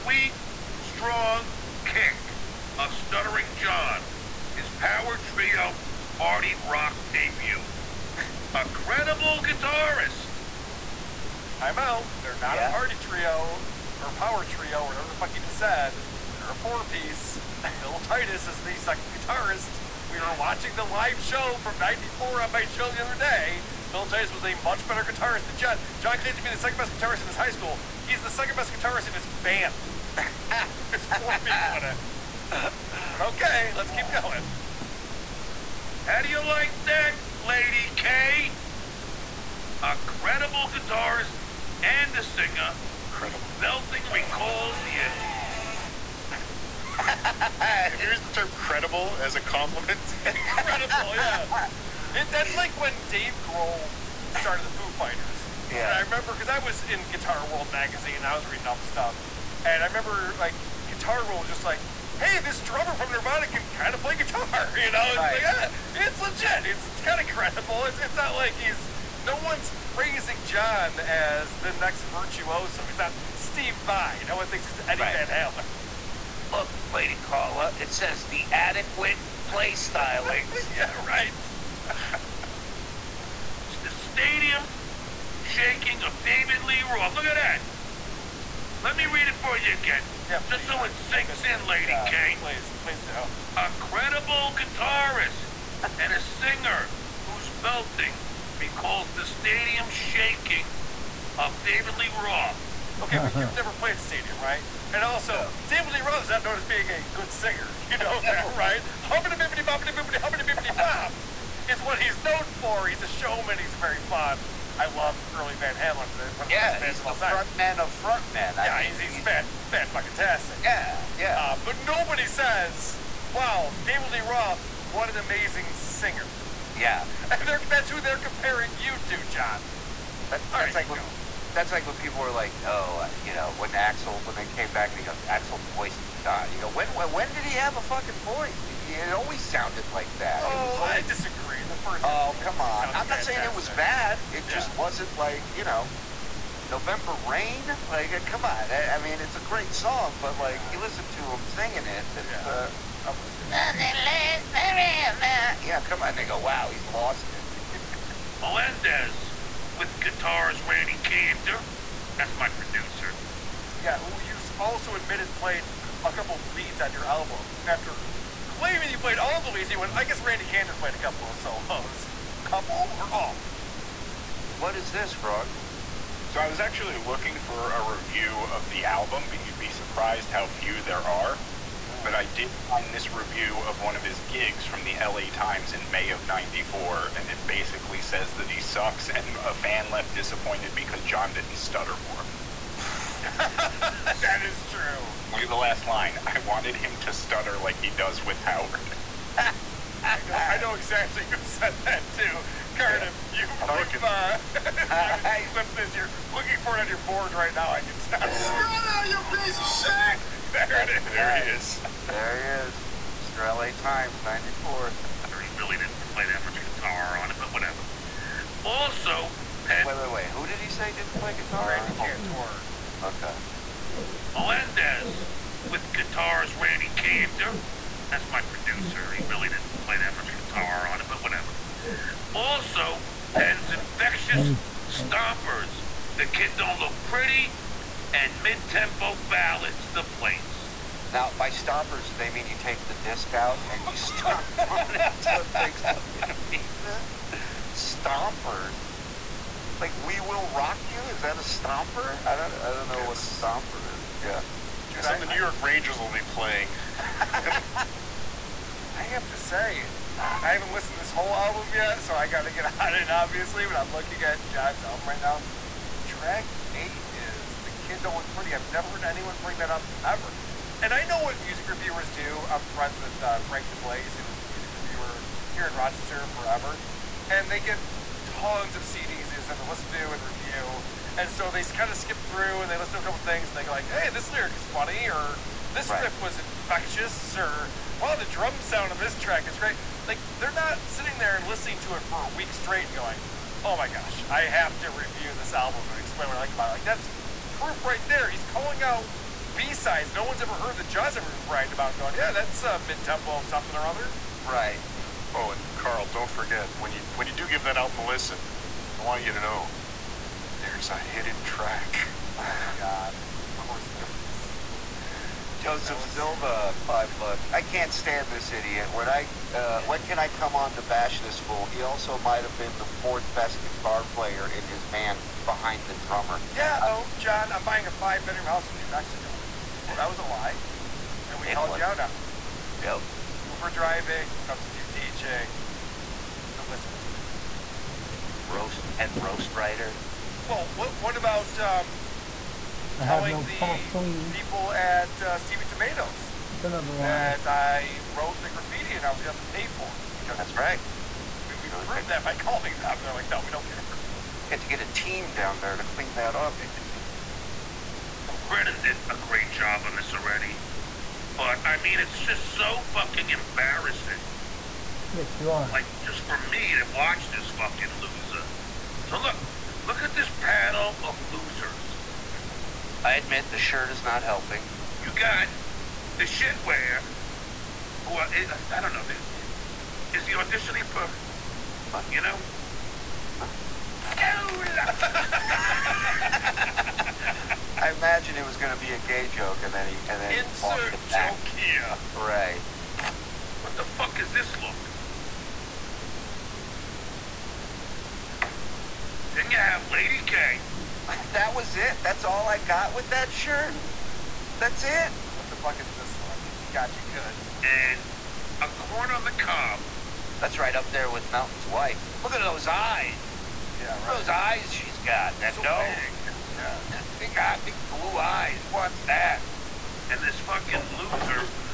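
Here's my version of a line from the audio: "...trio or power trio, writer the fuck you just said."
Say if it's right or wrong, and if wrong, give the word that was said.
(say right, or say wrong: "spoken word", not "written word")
wrong: "whatever", not "writer".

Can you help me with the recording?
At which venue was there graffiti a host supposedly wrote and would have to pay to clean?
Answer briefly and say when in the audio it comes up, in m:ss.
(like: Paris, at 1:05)
Stevie Tomatoes, at 5:45.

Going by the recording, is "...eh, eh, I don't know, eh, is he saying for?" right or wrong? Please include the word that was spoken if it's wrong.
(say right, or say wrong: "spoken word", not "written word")
wrong: "auditioning", not "saying".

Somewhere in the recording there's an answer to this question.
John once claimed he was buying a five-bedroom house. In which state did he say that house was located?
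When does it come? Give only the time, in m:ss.
5:28.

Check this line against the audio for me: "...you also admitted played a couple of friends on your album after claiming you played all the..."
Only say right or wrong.
wrong.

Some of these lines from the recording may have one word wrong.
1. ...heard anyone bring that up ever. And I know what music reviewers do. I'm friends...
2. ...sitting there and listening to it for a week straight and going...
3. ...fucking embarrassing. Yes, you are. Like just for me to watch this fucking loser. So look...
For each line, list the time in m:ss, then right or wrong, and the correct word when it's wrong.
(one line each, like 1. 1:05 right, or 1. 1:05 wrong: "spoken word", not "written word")
1. 4:28 right
2. 4:50 right
3. 6:02 right.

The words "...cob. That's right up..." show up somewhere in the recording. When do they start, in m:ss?
6:49.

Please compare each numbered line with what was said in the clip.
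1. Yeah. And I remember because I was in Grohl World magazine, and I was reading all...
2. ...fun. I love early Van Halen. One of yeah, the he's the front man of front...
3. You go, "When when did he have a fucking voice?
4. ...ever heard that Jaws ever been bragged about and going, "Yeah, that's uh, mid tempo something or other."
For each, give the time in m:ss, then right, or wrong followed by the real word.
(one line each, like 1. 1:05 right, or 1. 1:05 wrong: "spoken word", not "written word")
1. 0:55 wrong: "Guitar", not "Grohl"
2. 1:54 right
3. 2:16 right
4. 5:00 right.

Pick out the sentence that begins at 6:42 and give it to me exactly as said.
That's all I got with that shirt.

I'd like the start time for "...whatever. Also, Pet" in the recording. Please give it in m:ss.
3:37.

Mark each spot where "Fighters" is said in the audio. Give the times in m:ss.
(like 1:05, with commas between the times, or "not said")
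0:54.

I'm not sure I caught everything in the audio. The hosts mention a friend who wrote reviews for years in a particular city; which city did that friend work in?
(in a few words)
Rochester.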